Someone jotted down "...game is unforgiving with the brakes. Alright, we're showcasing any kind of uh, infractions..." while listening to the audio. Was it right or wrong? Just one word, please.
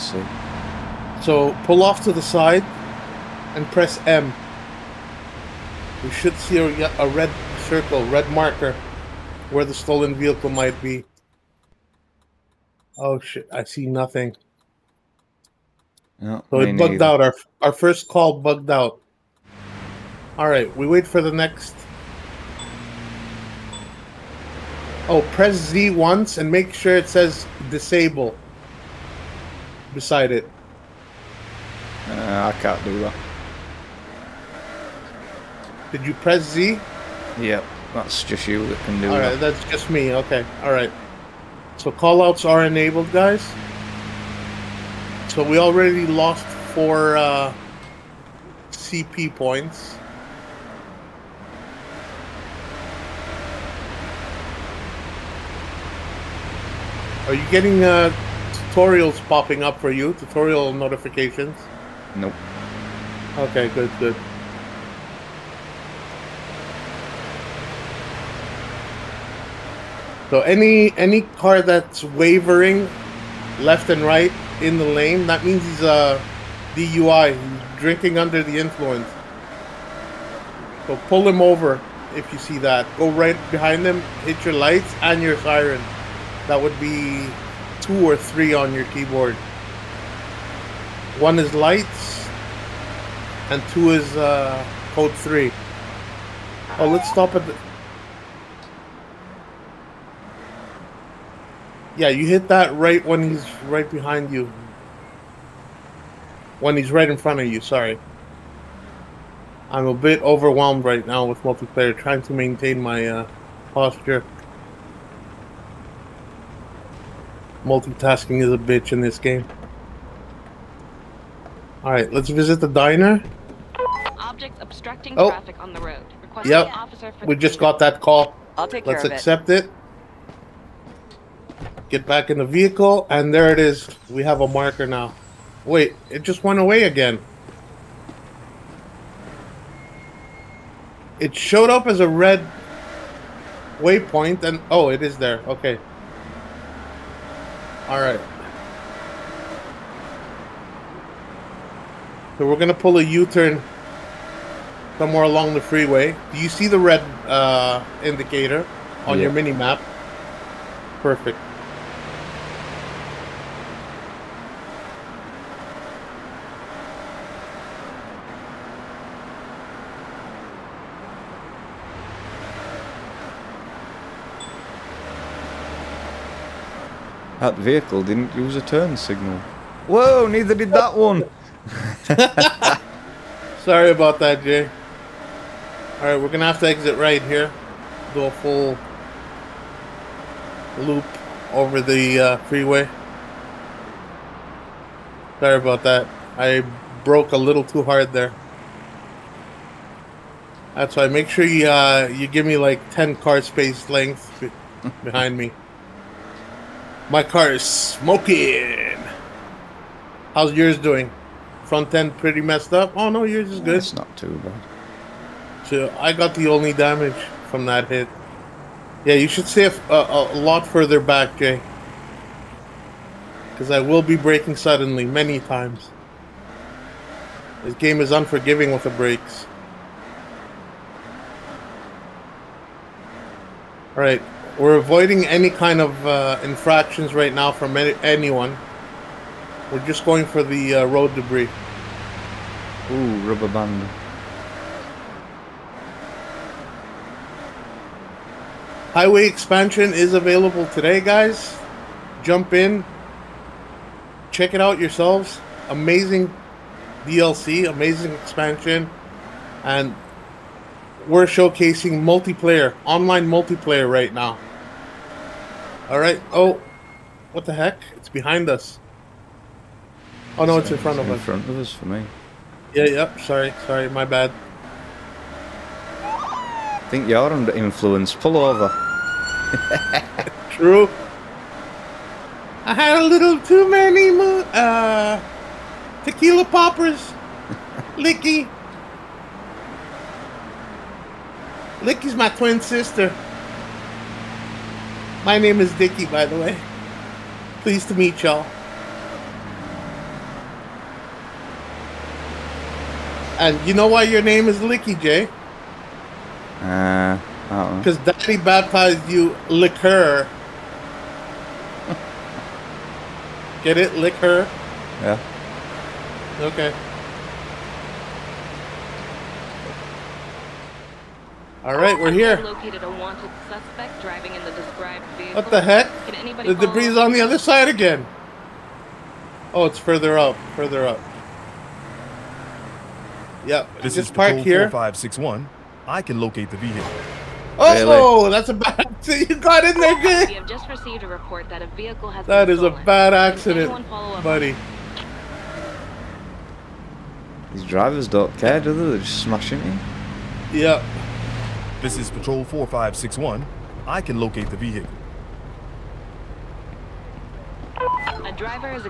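wrong.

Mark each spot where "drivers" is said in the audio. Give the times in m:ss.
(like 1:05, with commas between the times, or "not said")
5:47, 5:58.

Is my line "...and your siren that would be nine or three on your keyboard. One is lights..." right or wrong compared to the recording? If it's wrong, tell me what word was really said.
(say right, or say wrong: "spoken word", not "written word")
wrong: "two", not "nine".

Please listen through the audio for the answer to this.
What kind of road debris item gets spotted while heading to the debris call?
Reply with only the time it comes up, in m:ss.
4:03.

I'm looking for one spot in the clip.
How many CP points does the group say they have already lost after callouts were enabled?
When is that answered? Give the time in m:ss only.
0:46.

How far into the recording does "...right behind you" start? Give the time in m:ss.
1:43.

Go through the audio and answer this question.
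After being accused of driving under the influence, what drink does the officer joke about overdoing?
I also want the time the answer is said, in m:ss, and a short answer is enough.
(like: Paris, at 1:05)
Tequila poppers, at 4:46.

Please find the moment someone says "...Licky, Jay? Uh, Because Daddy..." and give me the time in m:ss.
5:04.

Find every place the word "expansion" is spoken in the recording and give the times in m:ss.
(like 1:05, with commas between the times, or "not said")
4:09, 4:18.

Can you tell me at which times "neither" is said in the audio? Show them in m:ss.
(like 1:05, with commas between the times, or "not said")
0:16, 3:00.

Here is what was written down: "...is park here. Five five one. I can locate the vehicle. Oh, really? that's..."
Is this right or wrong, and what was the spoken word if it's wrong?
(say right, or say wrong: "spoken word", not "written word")
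wrong: "six", not "five".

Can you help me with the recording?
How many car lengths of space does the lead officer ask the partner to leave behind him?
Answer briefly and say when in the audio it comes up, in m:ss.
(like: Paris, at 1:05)
10, at 3:22.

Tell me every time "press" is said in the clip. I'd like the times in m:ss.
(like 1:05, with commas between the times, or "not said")
0:03, 0:25, 0:36.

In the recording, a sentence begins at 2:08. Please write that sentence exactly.
I'll take let's care of accept it.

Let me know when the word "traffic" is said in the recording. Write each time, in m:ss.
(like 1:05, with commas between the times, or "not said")
2:05.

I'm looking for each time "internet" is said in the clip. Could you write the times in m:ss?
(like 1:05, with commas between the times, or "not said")
not said.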